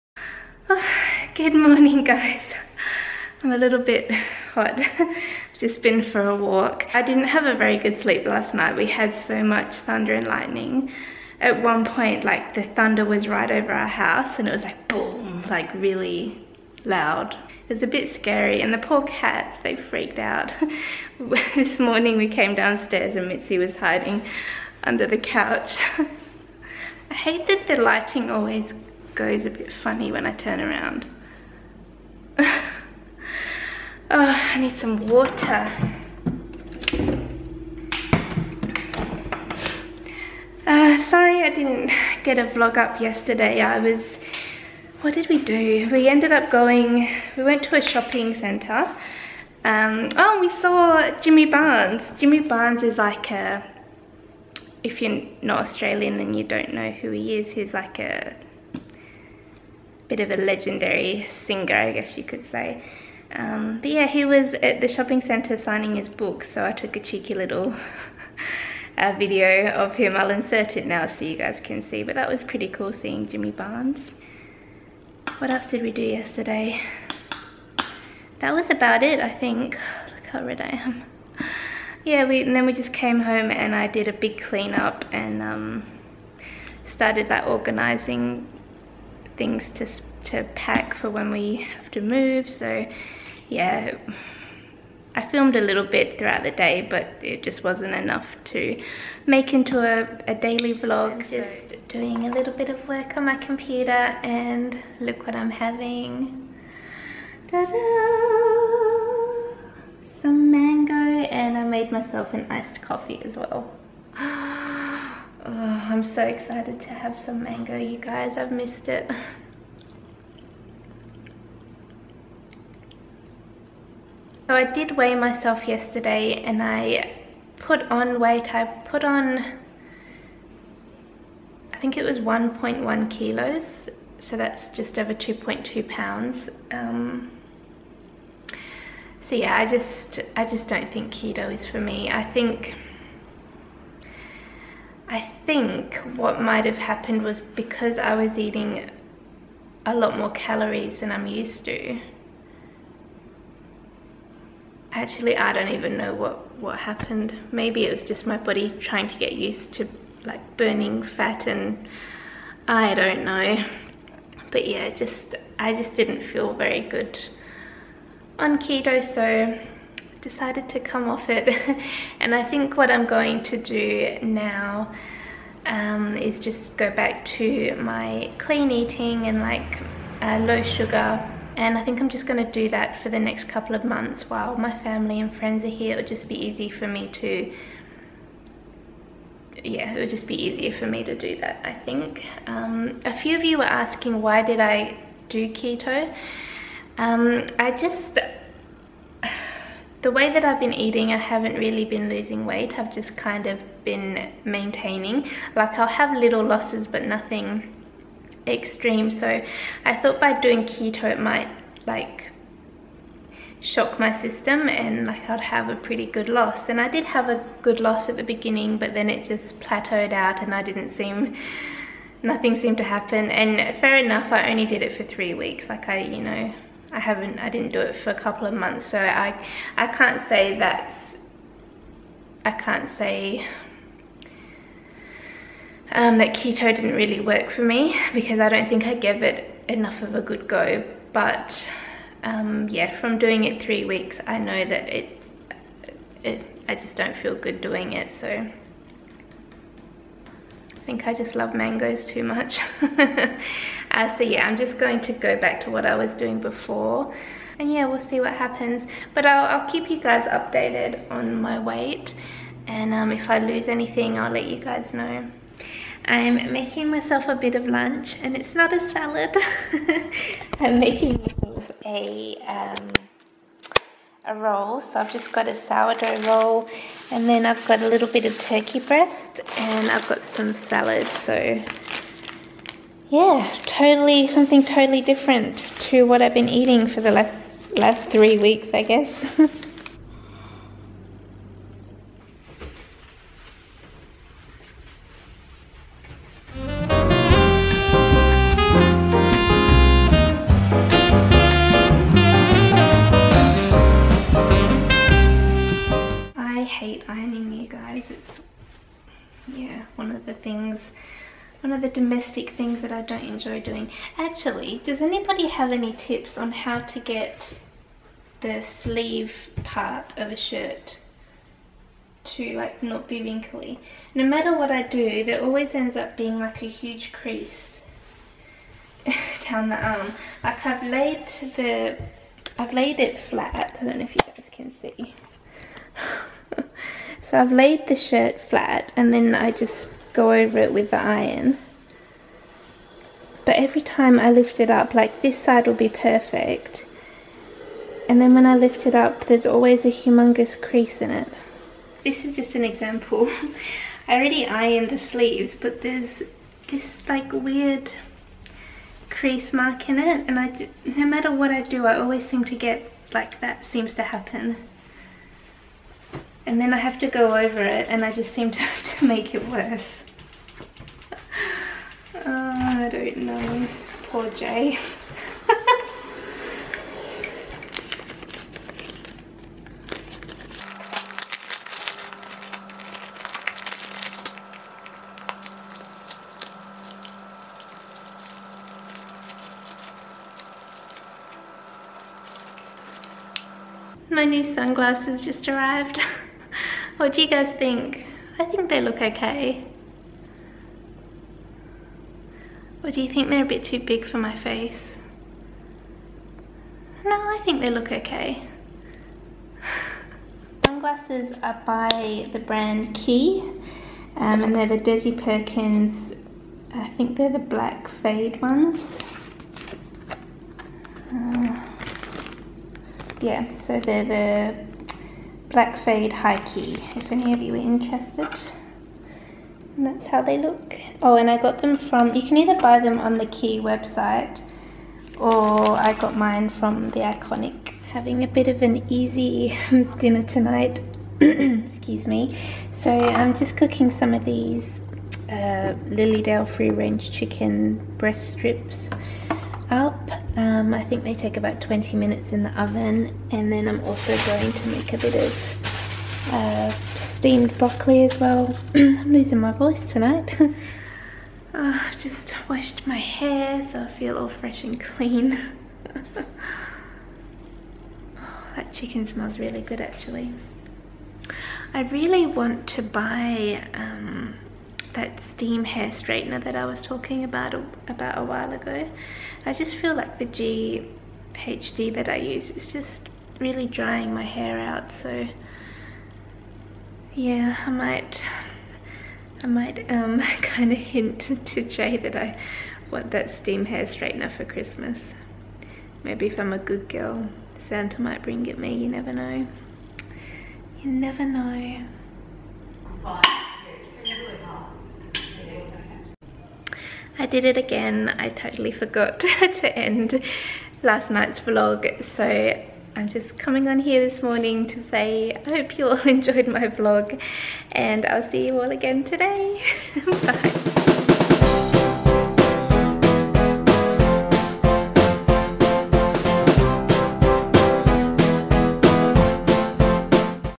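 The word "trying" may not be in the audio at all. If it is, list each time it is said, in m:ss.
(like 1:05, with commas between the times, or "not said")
2:38.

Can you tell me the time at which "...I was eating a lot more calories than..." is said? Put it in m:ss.
2:27.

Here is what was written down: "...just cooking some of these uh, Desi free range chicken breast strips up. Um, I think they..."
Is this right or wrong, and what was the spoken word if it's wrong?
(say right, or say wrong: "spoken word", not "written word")
wrong: "Lilydale", not "Desi".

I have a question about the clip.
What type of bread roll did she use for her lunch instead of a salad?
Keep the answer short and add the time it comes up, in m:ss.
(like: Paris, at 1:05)
Sourdough, at 4:35.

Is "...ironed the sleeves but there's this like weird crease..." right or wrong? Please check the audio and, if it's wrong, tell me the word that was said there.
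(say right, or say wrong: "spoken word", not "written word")
right.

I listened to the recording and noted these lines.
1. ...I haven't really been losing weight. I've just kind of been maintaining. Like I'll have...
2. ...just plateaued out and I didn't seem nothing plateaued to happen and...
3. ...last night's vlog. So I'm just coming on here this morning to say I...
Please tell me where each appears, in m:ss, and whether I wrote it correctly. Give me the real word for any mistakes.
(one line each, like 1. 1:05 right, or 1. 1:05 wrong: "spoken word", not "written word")
1. 3:21 right
2. 3:39 wrong: "seemed", not "plateaued"
3. 8:30 right.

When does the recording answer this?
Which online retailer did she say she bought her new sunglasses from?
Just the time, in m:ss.
7:16.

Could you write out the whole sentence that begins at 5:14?
Actually, does anybody have any tips on how to get the sleeve part of a shirt to like not be wrinkly?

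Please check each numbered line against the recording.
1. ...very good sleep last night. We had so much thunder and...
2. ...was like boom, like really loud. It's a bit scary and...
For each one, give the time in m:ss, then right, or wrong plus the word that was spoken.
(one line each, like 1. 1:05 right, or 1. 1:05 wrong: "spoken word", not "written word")
1. 0:07 right
2. 0:14 right.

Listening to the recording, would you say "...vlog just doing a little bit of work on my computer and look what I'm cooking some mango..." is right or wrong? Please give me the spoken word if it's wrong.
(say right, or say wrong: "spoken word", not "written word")
wrong: "having", not "cooking".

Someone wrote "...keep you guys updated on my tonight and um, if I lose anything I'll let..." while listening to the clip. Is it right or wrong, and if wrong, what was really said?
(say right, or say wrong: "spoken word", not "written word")
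wrong: "weight", not "tonight".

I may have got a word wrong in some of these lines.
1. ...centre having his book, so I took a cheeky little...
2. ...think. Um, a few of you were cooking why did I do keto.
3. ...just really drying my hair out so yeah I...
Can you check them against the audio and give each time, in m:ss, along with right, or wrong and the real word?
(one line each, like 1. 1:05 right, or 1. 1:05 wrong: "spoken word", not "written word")
1. 1:05 wrong: "signing", not "having"
2. 3:11 wrong: "asking", not "cooking"
3. 8:02 right.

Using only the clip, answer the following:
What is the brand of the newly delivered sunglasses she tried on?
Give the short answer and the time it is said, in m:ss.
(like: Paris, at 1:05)
Quay, at 6:52.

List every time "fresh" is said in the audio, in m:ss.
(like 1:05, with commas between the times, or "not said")
7:44.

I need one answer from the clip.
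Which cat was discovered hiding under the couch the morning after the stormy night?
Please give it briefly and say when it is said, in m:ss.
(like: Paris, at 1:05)
Mitzi, at 0:23.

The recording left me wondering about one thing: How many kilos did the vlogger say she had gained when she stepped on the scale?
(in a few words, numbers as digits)
1.1 kilos.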